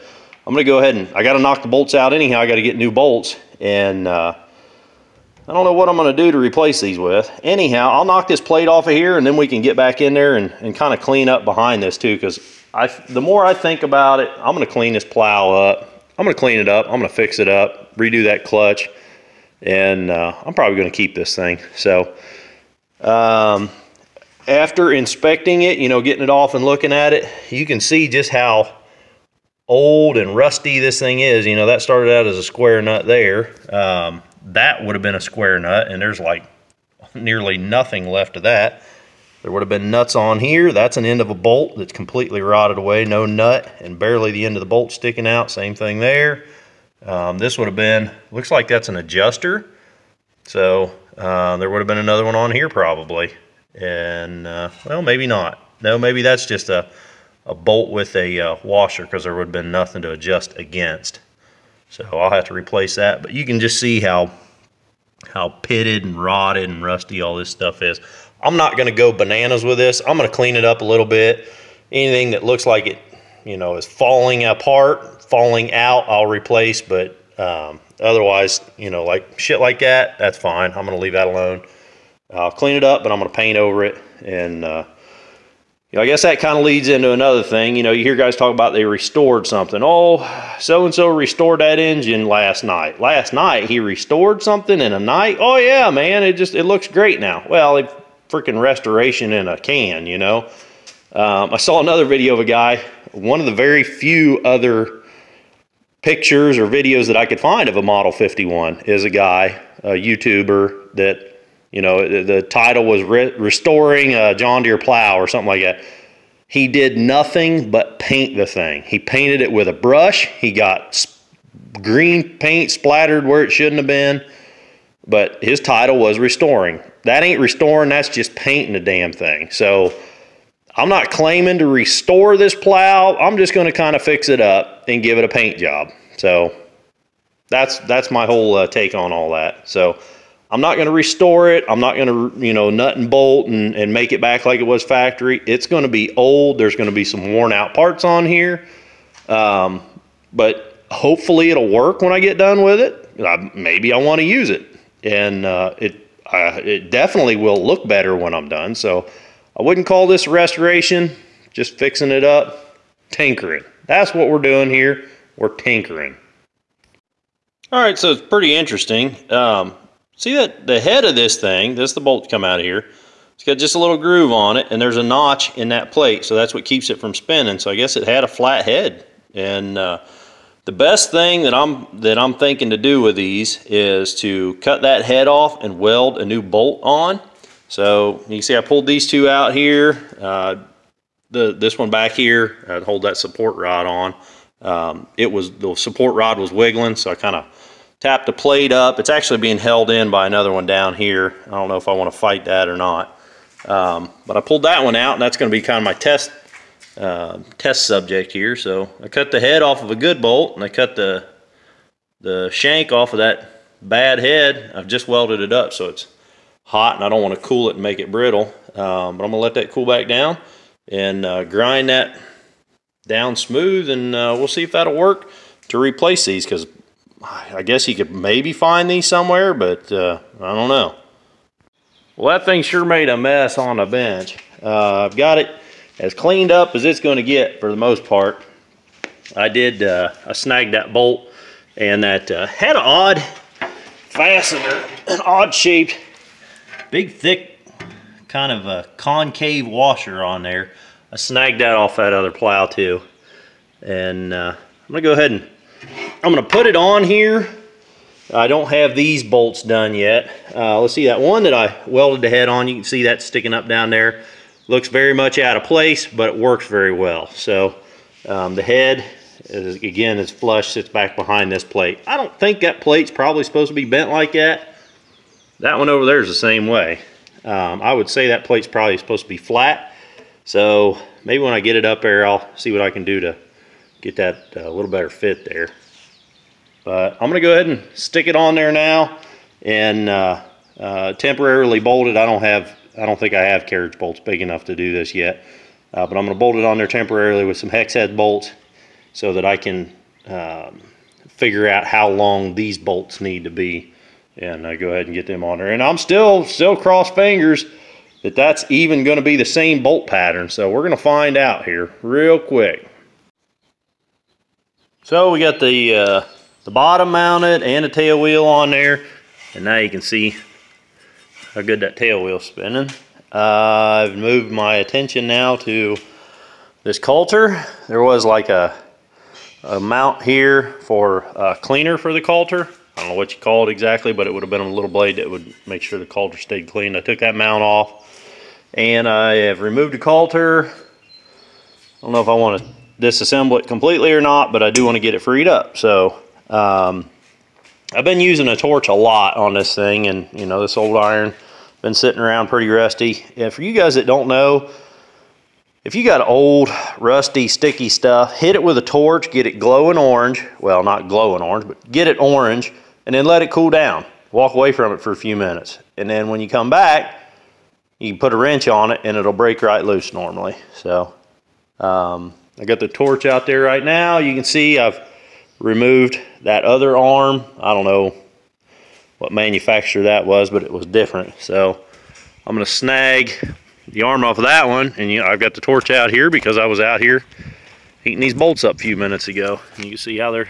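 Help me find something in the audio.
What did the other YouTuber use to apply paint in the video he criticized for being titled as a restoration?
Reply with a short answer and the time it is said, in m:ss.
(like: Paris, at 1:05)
a brush, at 1:59.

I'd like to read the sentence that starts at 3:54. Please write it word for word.
Uh, I've got it as cleaned up as it's going to get for the most part.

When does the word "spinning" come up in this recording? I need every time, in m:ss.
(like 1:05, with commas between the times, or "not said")
2:57, 5:22.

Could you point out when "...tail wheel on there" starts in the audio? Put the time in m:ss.
5:17.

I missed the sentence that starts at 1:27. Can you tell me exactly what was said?
You know, you hear guys talk about they restored something.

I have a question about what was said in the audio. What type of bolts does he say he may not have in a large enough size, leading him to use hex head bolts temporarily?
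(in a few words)
carriage bolts.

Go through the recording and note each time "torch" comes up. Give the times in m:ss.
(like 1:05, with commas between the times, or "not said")
5:48, 5:58, 6:12, 6:25.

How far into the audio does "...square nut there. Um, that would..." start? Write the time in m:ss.
0:32.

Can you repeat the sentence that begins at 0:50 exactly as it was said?
So uh, there would have been another one on here probably.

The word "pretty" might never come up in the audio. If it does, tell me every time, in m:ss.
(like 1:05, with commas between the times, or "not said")
2:48, 5:52.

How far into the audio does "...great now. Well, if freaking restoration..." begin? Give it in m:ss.
1:36.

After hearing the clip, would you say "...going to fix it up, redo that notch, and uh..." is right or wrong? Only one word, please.
wrong.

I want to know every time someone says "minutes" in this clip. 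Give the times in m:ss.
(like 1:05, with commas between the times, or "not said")
6:05, 6:28.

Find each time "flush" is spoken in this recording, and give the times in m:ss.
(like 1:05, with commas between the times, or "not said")
4:30.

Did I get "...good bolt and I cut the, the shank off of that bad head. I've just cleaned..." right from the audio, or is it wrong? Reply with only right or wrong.
wrong.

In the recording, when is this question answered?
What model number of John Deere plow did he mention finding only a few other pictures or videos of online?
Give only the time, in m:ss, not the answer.
1:47.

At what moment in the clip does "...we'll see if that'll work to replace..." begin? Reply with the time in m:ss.
3:44.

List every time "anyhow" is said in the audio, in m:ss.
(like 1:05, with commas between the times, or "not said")
0:02, 0:07.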